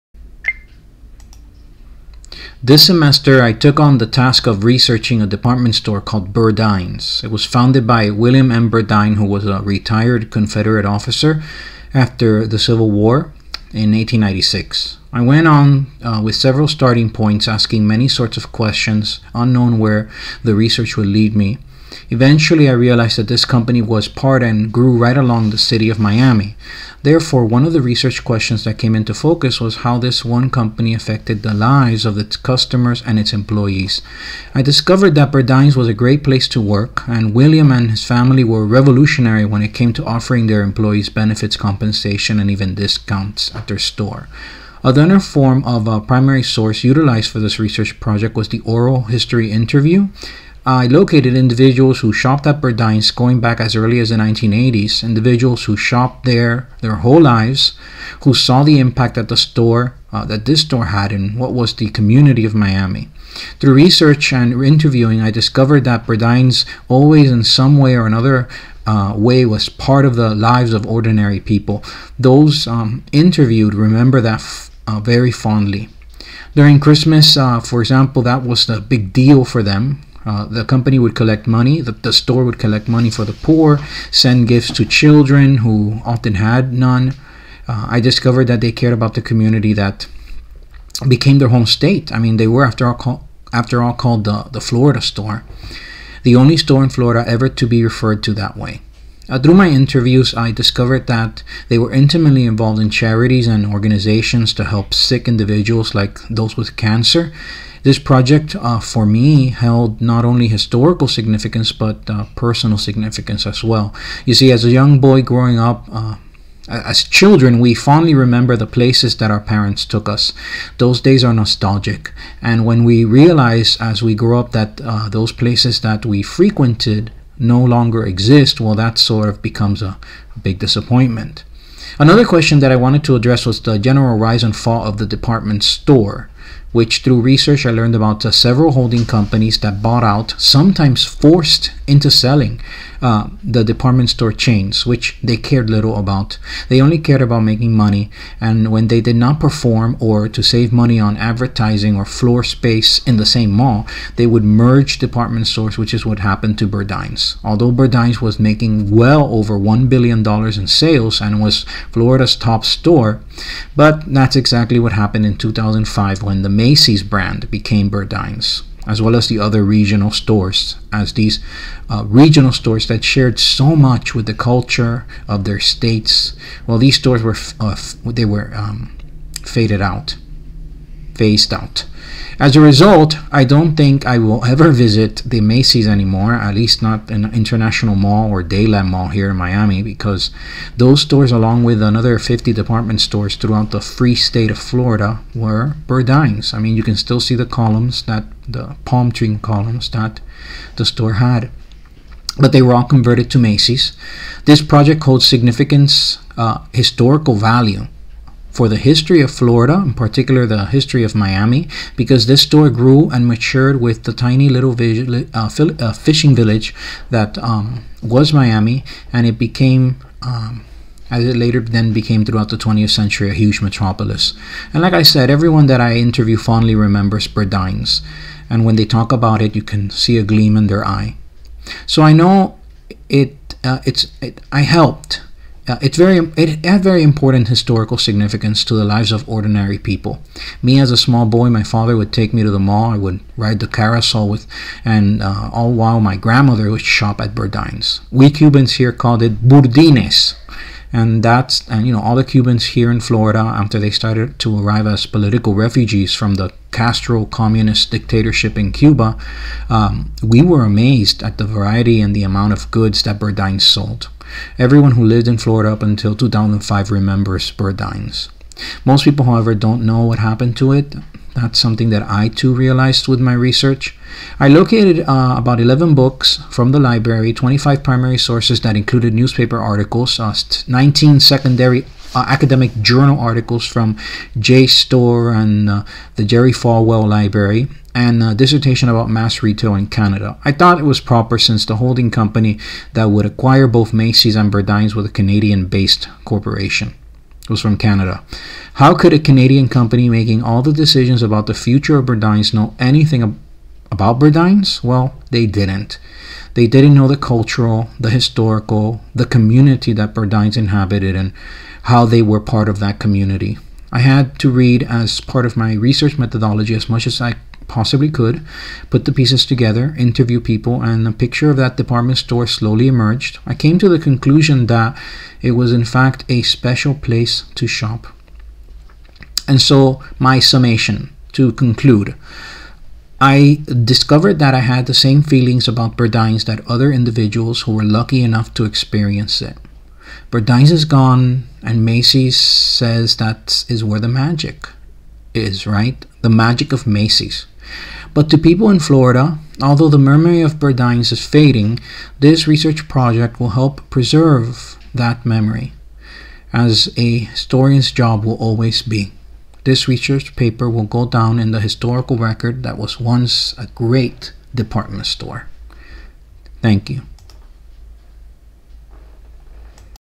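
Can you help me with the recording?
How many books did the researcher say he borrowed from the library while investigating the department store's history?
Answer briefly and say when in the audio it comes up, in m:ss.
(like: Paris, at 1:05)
11, at 4:35.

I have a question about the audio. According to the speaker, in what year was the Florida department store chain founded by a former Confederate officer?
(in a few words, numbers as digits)
1896.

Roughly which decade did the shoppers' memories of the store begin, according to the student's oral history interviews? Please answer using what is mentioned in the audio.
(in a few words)
1980s.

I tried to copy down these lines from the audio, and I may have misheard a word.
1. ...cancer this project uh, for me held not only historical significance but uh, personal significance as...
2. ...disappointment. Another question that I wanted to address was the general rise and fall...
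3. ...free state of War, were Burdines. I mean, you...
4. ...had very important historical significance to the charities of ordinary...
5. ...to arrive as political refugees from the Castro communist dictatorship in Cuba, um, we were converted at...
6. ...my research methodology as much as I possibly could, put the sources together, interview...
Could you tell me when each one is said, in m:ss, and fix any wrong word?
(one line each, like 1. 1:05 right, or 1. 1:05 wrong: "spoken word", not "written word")
1. 1:46 right
2. 2:10 right
3. 3:13 wrong: "Florida", not "War"
4. 3:56 wrong: "lives", not "charities"
5. 4:14 wrong: "amazed", not "converted"
6. 5:15 wrong: "pieces", not "sources".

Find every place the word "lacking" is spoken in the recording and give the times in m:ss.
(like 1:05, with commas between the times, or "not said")
not said.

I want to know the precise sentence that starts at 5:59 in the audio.
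This research paper will go down in the historical record that was once a great department store.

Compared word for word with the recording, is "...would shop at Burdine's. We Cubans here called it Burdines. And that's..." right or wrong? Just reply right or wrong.
right.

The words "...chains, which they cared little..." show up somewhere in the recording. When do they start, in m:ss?
2:24.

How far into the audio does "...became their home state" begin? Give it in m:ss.
1:31.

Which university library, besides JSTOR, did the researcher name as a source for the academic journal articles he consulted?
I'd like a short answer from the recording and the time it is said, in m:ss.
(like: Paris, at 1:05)
Jerry Falwell Library, at 4:46.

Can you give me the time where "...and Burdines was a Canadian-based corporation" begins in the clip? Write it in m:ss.
4:54.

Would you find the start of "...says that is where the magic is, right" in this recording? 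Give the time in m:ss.
5:42.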